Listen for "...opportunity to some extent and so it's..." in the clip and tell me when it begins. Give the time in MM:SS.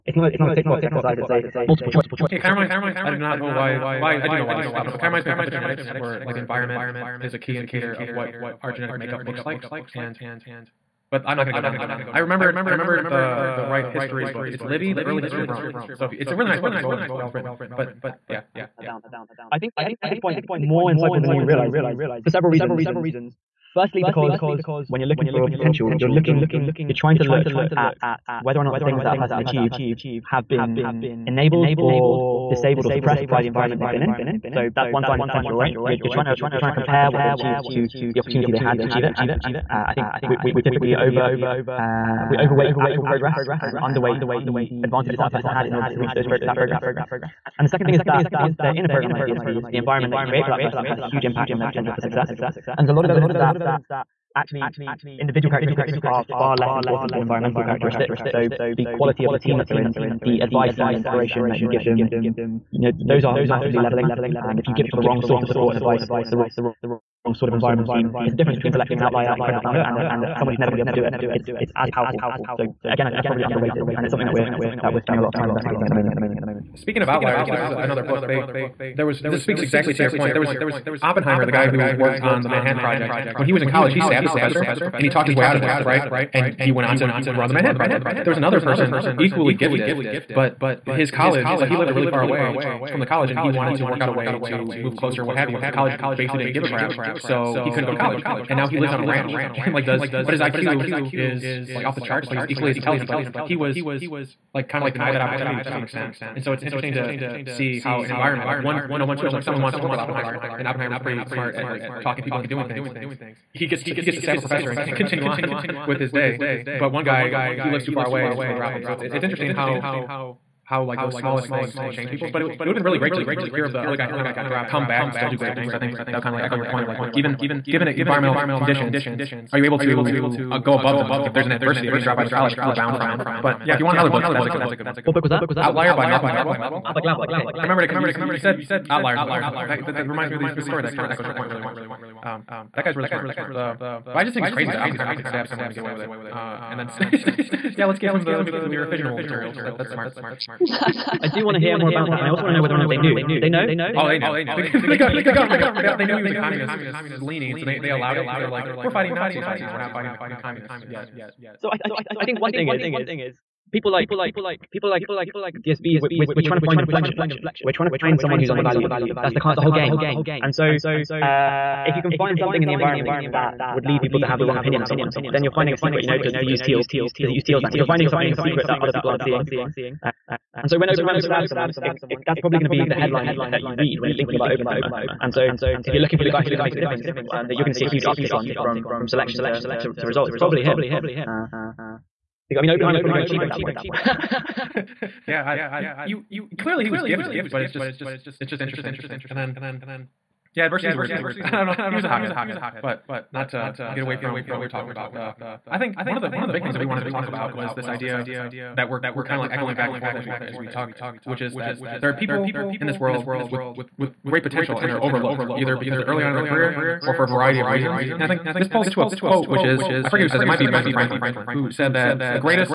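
01:45.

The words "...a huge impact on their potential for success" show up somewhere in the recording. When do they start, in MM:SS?
00:50.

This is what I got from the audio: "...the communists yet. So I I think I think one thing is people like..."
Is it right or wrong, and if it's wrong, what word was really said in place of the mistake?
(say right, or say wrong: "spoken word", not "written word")
right.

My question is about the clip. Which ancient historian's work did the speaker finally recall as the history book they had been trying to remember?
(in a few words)
Livy.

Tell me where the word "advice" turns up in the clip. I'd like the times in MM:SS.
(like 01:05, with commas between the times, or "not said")
01:00, 01:05.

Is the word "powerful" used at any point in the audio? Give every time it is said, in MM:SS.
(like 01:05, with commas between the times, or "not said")
01:11.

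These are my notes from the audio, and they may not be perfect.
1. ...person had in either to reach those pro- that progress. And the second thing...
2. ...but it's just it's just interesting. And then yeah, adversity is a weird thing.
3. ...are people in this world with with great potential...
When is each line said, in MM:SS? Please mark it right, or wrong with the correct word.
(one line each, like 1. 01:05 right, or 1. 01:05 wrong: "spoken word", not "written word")
1. 00:45 wrong: "order", not "either"
2. 03:17 right
3. 03:32 right.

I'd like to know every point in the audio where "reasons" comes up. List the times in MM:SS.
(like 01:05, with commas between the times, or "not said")
00:22, 03:37.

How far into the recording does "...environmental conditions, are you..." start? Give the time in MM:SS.
02:07.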